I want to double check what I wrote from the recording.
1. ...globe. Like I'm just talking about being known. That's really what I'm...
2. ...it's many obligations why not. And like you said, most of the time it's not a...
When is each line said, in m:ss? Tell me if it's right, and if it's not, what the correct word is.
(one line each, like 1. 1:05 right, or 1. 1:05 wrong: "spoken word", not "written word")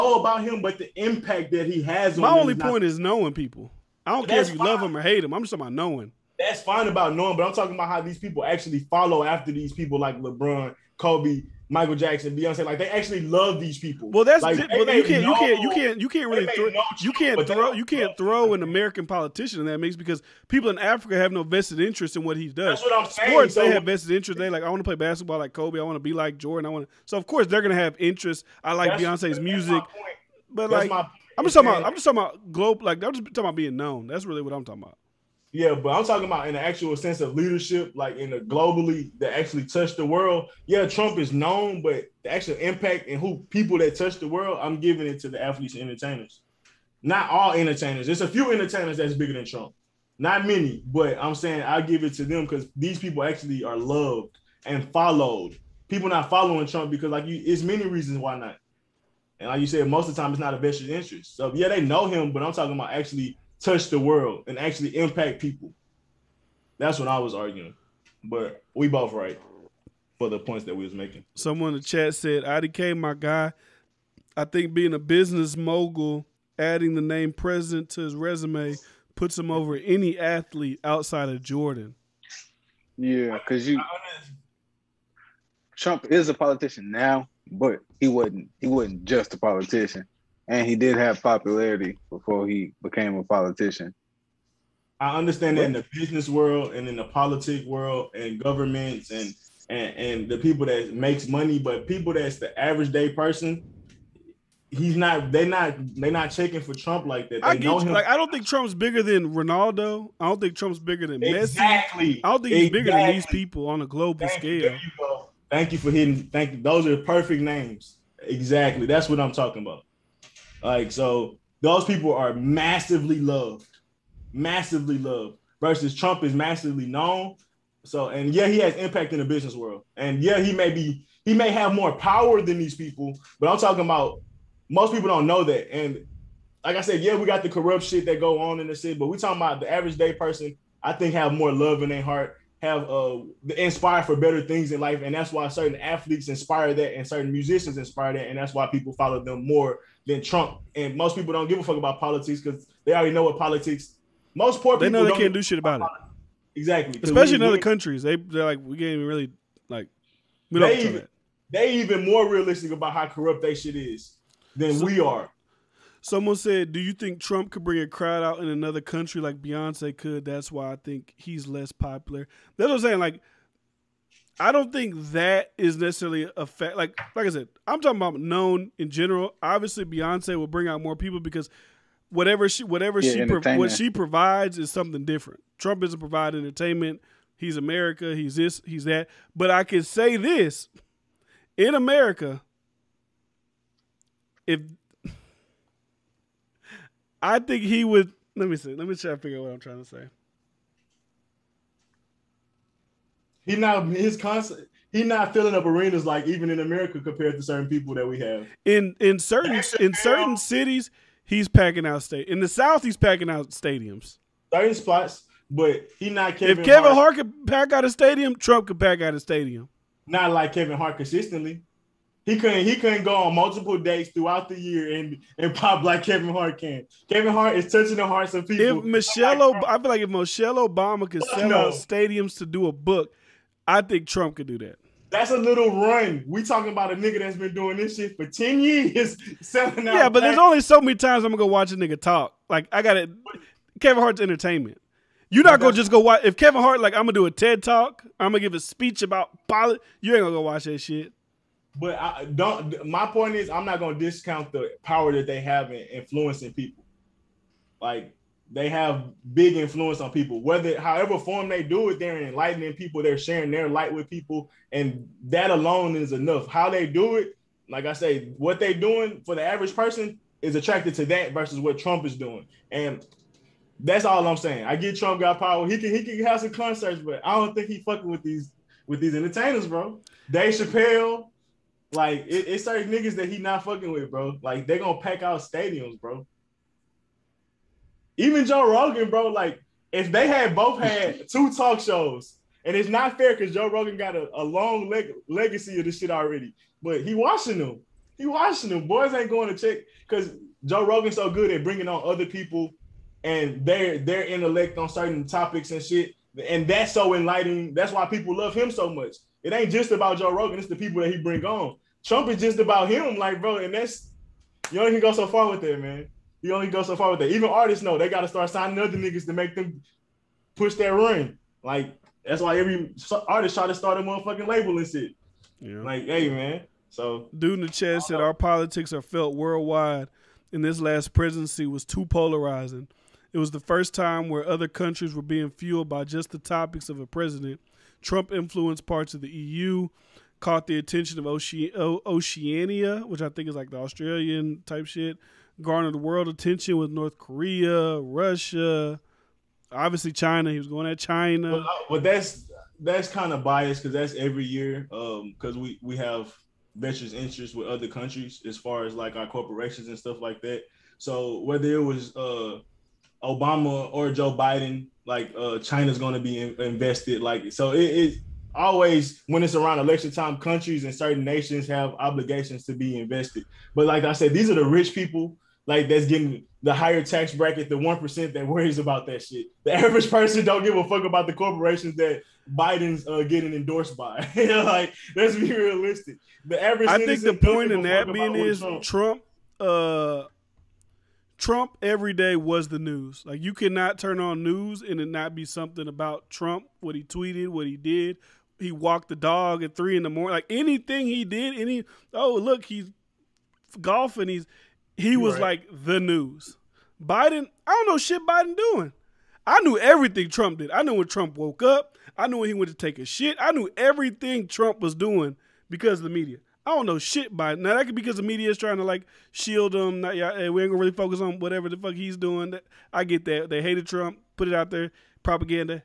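1. 0:32 right
2. 0:57 wrong: "reasons", not "obligations".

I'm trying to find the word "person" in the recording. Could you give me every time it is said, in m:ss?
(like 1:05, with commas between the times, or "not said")
1:43, 2:20, 4:29, 6:20.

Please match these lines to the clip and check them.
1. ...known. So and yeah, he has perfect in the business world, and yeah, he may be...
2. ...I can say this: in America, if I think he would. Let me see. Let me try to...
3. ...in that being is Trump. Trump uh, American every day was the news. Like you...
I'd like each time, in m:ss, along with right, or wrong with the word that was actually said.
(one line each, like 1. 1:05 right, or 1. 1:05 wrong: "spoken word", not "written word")
1. 2:06 wrong: "impact", not "perfect"
2. 3:09 right
3. 6:27 wrong: "Trump", not "American".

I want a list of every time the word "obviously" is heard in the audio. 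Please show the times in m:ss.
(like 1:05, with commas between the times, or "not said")
2:59, 5:49.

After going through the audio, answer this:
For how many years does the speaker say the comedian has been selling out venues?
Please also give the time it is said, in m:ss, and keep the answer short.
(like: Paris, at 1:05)
10, at 3:58.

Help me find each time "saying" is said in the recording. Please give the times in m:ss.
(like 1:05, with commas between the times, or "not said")
0:23, 0:51, 2:52, 4:34.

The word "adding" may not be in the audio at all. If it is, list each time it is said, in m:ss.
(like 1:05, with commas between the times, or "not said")
1:16.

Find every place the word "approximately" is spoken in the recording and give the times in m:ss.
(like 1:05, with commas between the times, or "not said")
not said.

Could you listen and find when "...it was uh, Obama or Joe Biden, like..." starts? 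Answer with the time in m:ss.
6:01.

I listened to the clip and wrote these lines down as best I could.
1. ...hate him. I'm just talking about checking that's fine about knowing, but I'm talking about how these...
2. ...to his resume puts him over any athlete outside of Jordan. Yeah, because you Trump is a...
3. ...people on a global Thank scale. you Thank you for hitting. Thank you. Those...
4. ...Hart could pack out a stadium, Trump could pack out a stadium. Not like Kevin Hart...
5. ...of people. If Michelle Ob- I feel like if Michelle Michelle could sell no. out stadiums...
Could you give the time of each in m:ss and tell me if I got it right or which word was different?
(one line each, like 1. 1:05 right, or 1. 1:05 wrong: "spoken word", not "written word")
1. 0:05 wrong: "knowing", not "checking"
2. 1:17 right
3. 1:53 right
4. 3:37 right
5. 3:48 wrong: "Obama", not "Michelle".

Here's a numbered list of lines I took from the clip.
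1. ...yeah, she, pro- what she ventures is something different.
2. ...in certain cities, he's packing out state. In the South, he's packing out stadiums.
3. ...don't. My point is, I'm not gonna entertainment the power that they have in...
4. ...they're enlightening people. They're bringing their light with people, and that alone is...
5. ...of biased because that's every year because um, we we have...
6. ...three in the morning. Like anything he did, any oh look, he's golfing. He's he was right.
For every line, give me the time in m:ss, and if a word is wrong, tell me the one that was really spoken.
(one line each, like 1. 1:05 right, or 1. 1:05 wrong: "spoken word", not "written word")
1. 3:02 wrong: "provides", not "ventures"
2. 3:29 right
3. 4:12 wrong: "discount", not "entertainment"
4. 4:21 wrong: "sharing", not "bringing"
5. 5:53 right
6. 6:39 right.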